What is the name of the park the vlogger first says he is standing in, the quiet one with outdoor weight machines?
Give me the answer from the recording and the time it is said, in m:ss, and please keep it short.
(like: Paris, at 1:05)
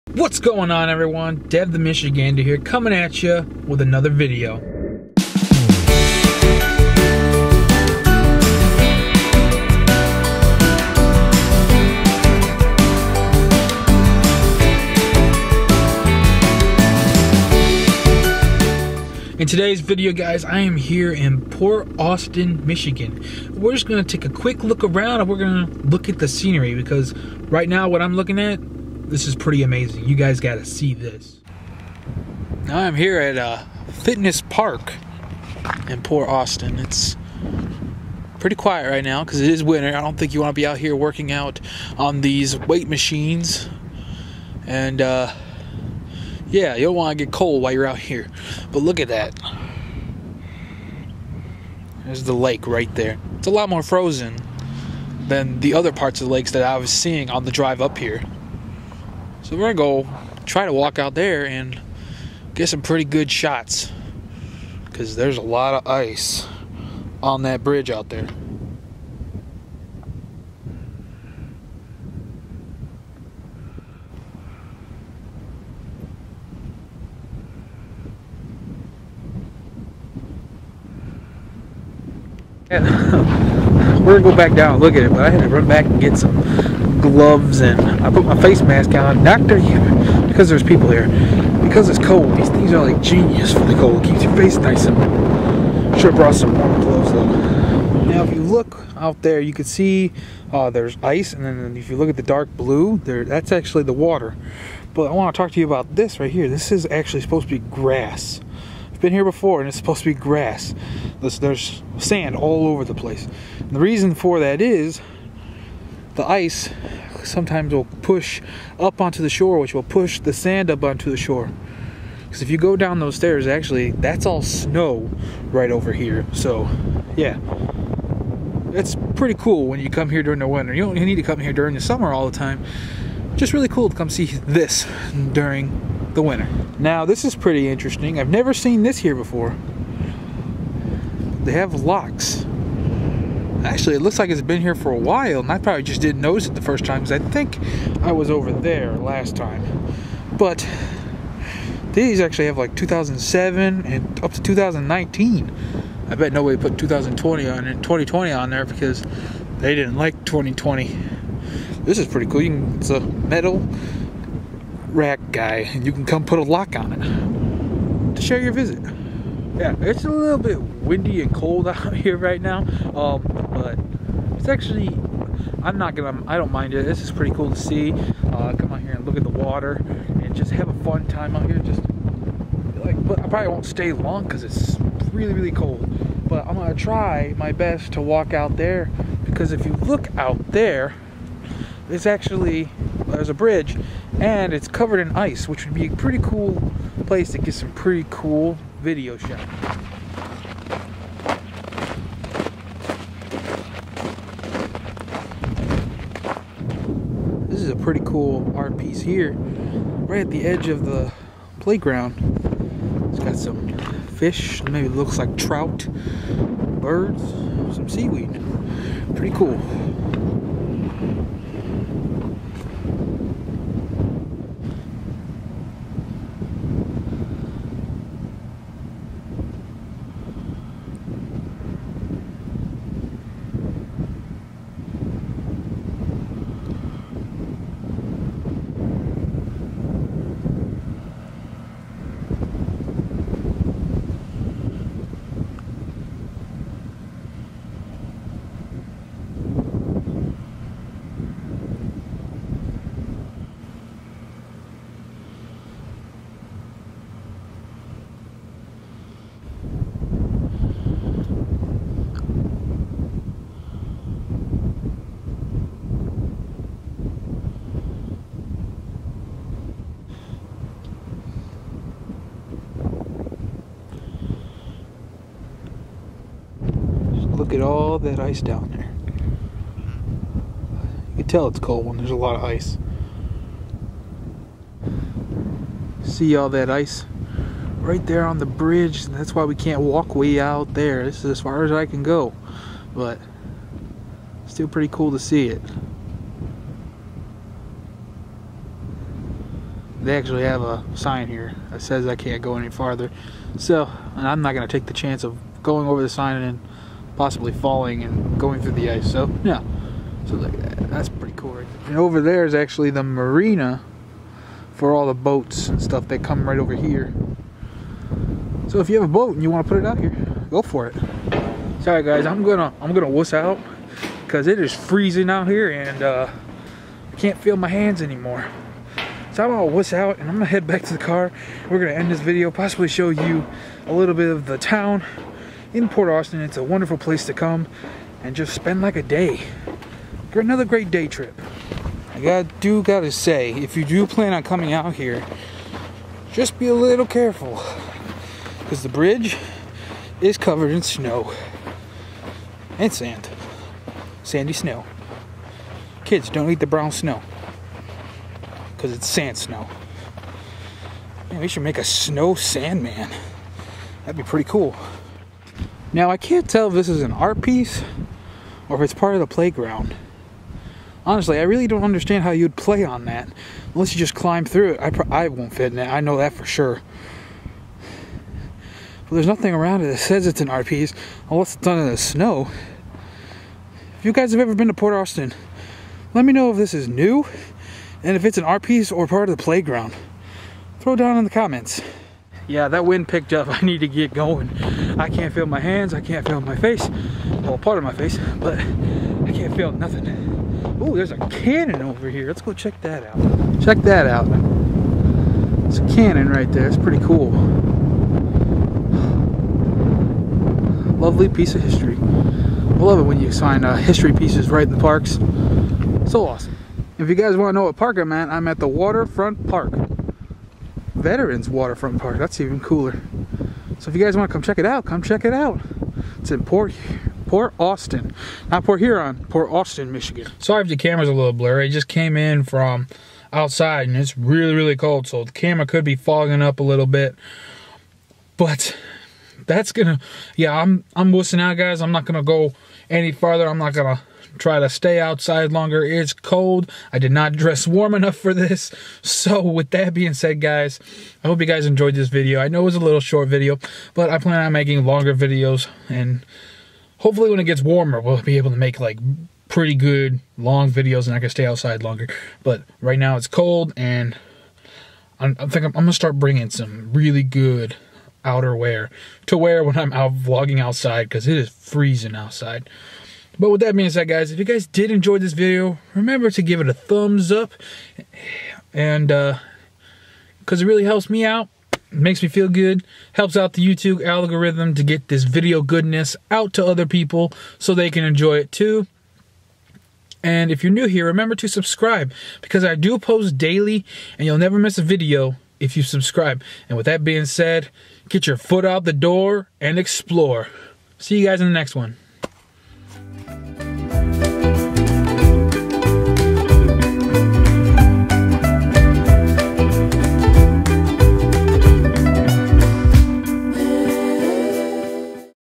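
Fitness Park, at 0:33.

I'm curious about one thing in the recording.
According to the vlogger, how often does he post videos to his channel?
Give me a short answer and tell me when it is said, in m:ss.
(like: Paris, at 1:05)
daily, at 8:13.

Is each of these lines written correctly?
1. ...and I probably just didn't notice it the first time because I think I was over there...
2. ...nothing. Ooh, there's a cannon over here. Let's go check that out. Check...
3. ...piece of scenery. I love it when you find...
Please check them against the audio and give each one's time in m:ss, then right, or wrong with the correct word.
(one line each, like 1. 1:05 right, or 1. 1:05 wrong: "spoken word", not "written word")
1. 2:25 right
2. 6:39 right
3. 6:51 wrong: "history", not "scenery".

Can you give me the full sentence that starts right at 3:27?
pretty cool art piece here, right at the edge of the playground.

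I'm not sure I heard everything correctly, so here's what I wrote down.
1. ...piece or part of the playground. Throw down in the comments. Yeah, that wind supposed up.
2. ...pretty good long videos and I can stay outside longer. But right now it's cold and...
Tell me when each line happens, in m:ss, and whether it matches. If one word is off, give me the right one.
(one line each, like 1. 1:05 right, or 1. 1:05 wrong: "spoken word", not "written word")
1. 6:28 wrong: "picked", not "supposed"
2. 7:39 right.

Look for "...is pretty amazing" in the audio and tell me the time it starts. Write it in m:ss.
0:29.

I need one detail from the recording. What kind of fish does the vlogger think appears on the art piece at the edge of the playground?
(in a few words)
trout.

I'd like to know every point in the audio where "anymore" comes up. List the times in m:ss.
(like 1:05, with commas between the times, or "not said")
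5:28.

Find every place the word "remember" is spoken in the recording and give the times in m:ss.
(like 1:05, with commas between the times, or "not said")
7:55, 8:11.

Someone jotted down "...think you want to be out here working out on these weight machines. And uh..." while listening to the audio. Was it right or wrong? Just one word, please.
right.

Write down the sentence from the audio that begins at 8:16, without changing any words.
And with that being said, get your foot out the door and explore.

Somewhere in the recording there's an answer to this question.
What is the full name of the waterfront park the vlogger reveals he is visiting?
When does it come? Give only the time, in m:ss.
7:00.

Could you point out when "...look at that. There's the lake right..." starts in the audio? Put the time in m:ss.
0:48.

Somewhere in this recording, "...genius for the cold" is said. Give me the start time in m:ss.
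1:33.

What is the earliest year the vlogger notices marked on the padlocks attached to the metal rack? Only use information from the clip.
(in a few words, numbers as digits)
2007.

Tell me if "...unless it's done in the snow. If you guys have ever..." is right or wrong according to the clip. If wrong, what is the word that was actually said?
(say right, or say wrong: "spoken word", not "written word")
right.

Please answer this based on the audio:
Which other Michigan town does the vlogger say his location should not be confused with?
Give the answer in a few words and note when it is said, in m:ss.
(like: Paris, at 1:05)
Port Huron, at 7:08.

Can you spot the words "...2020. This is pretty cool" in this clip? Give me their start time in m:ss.
2:40.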